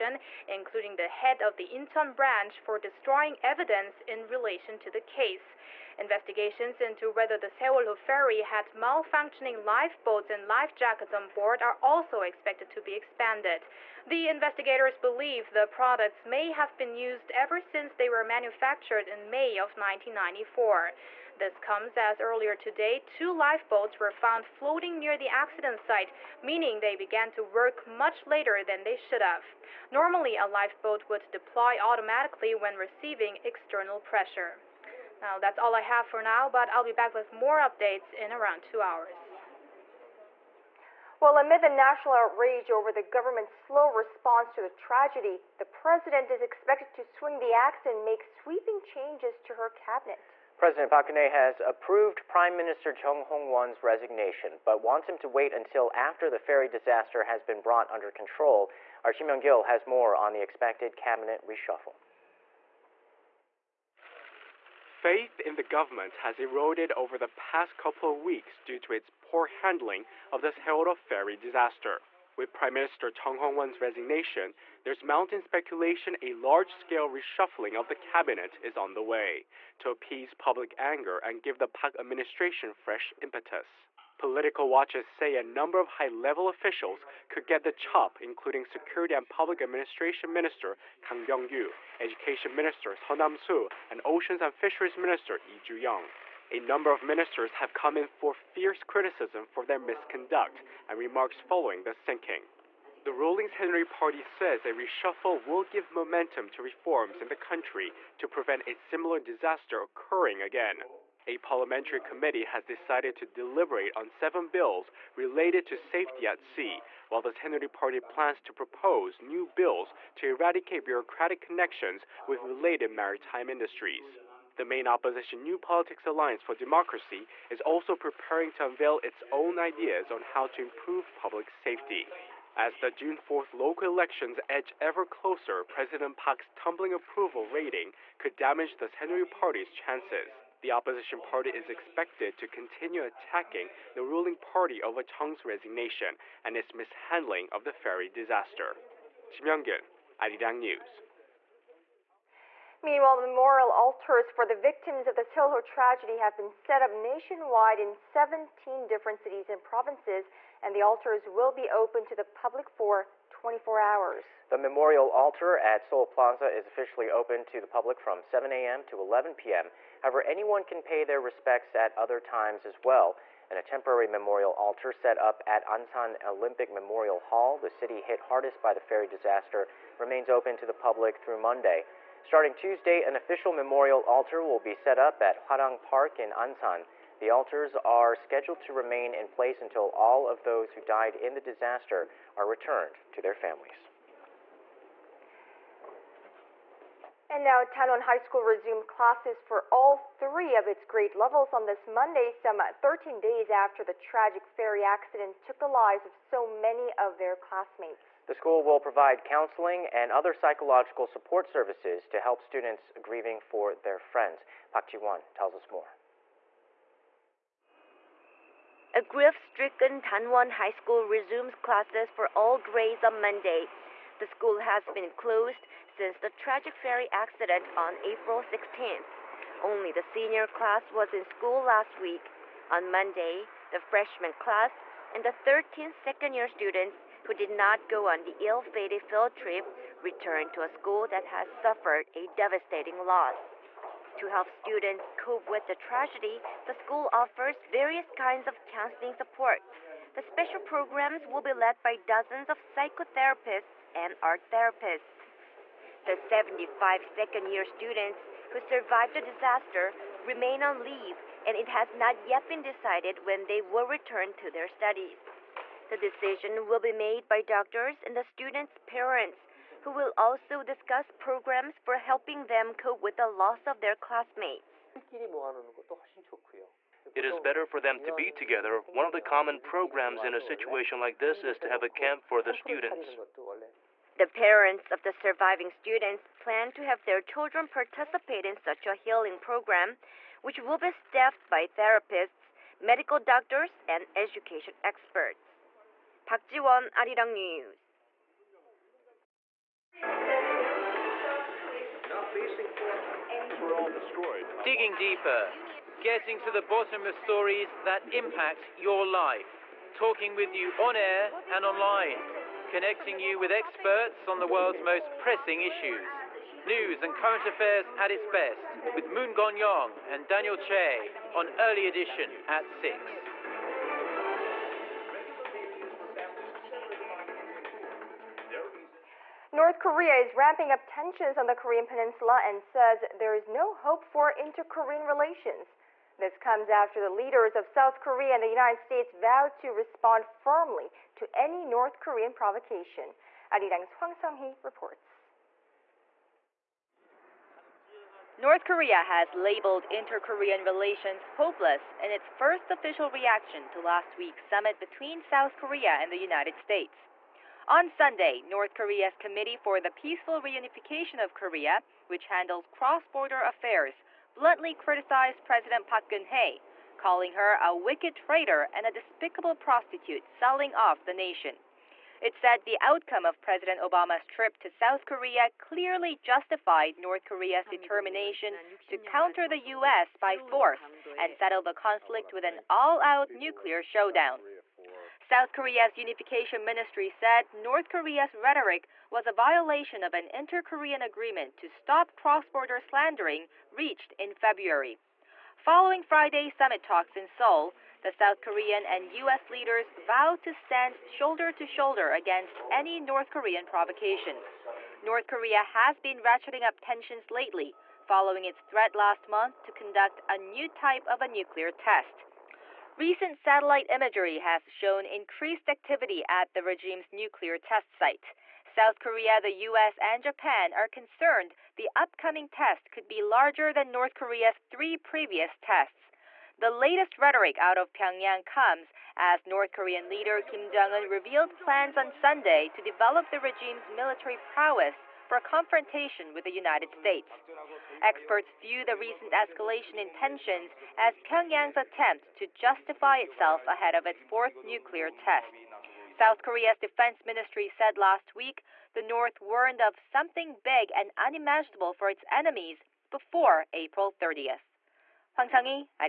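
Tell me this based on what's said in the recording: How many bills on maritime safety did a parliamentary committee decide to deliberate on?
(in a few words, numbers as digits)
7.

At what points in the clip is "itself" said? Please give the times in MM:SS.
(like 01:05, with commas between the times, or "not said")
07:23.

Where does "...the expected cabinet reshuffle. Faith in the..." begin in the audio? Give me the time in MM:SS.
01:00.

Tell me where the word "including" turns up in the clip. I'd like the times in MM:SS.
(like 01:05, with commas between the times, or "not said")
00:00, 01:28.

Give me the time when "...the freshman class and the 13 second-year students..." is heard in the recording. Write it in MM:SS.
03:53.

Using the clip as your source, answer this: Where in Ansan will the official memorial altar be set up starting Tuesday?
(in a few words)
Hwarang Park.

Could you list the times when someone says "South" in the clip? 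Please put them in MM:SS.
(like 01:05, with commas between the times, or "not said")
05:37, 05:55, 06:14, 06:25, 06:38, 06:58, 07:26.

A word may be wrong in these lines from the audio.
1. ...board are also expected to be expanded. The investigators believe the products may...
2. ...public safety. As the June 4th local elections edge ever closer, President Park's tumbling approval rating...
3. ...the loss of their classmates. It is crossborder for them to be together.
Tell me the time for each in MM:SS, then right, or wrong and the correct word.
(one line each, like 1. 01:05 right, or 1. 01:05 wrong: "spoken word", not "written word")
1. 00:11 right
2. 02:11 right
3. 04:33 wrong: "better", not "crossborder".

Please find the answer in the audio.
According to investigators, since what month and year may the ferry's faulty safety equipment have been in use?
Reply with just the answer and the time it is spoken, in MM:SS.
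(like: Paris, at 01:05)
May 1994, at 00:19.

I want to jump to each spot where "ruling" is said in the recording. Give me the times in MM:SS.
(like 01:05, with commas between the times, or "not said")
01:43, 02:24.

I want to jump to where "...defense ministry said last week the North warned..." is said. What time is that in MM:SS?
07:26.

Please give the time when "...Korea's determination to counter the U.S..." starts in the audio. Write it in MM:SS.
06:17.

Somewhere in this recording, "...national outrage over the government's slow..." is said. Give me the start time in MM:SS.
00:41.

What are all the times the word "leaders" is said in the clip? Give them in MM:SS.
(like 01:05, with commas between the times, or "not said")
05:37, 06:39, 07:10.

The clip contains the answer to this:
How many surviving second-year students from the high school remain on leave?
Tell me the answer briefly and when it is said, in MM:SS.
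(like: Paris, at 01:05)
75, at 04:16.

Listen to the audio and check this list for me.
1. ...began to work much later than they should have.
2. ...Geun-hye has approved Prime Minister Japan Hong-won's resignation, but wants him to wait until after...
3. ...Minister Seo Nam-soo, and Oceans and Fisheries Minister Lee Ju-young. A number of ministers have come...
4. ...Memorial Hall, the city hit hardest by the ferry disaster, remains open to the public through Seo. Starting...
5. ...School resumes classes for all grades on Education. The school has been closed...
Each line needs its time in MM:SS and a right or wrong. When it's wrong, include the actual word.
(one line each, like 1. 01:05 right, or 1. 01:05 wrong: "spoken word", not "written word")
1. 00:26 right
2. 00:51 wrong: "Chung", not "Japan"
3. 01:32 right
4. 02:56 wrong: "Monday", not "Seo"
5. 03:40 wrong: "Monday", not "Education".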